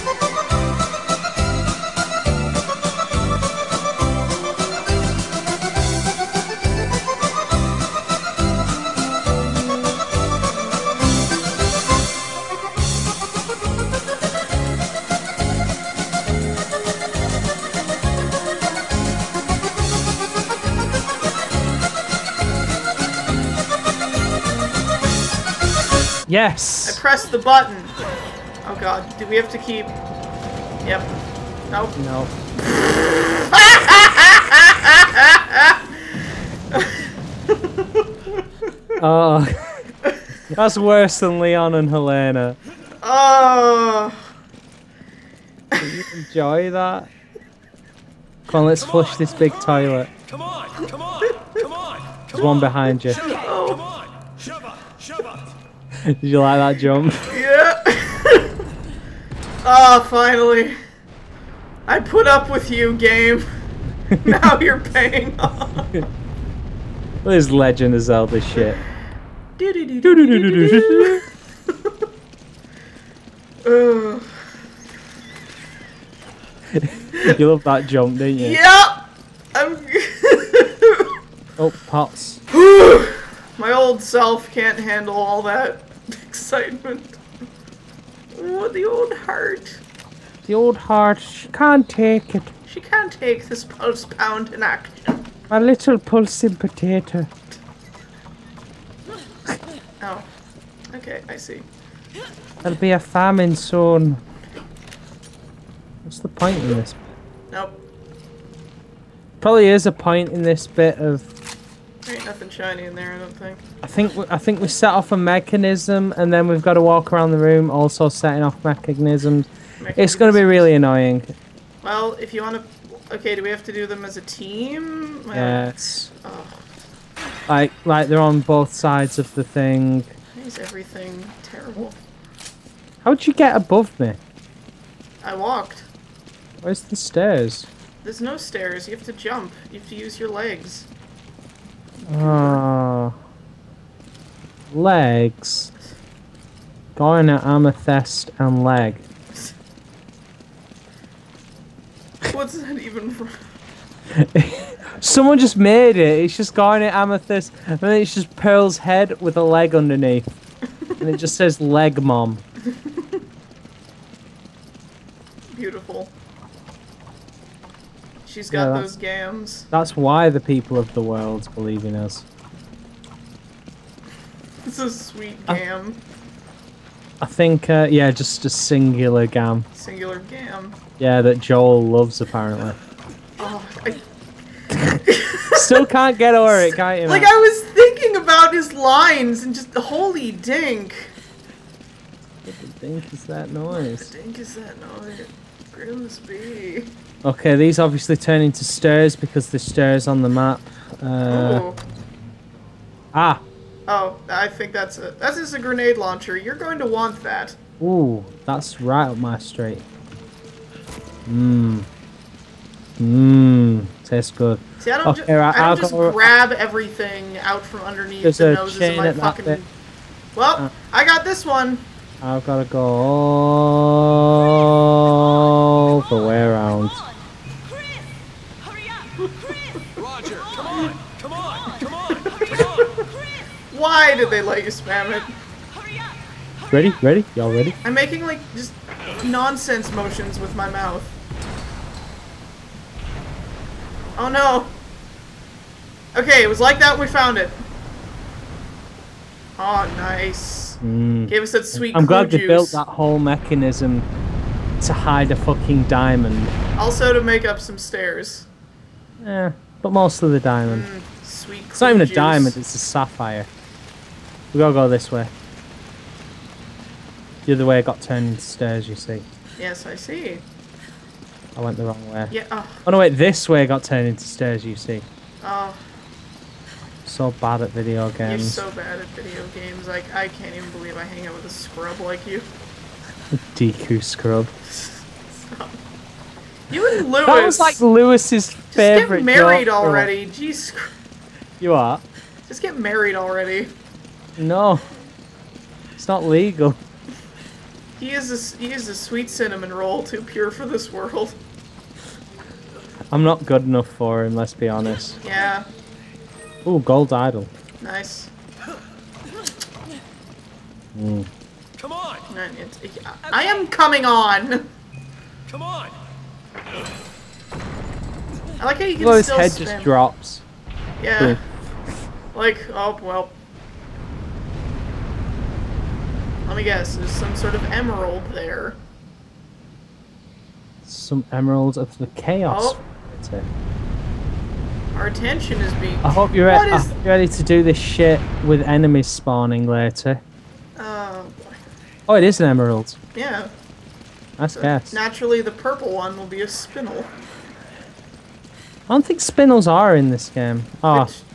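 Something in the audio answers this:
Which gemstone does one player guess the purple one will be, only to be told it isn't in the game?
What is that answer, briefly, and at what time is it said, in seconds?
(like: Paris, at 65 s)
spinel, at 346 s.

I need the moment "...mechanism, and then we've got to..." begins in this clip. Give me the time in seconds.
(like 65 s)
115 s.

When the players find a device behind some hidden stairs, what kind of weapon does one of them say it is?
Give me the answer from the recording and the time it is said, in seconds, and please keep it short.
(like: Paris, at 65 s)
grenade launcher, at 205 s.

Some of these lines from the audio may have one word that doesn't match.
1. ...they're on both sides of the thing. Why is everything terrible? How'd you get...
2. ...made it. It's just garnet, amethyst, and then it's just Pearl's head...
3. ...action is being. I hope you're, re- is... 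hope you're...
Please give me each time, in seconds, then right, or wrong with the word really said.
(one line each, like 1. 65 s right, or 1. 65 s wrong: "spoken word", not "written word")
1. 128 s right
2. 155 s right
3. 335 s wrong: "attention", not "action".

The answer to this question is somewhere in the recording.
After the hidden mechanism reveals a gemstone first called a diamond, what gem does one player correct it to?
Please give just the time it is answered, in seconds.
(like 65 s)
262 s.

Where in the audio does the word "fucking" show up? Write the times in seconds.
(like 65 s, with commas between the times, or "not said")
219 s, 255 s.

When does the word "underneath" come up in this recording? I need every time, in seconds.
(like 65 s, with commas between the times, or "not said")
159 s, 217 s.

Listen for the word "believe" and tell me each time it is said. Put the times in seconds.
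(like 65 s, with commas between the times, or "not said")
171 s, 280 s.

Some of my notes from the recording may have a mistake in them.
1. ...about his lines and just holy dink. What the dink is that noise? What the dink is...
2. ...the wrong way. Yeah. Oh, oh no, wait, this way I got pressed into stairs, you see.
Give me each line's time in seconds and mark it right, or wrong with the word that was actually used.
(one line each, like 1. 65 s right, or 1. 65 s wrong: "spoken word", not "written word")
1. 188 s right
2. 271 s wrong: "turned", not "pressed".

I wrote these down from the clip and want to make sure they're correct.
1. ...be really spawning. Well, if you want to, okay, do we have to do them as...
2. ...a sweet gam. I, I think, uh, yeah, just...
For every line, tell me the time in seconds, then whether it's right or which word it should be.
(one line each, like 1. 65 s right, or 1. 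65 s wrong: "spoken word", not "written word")
1. 120 s wrong: "annoying", not "spawning"
2. 174 s right.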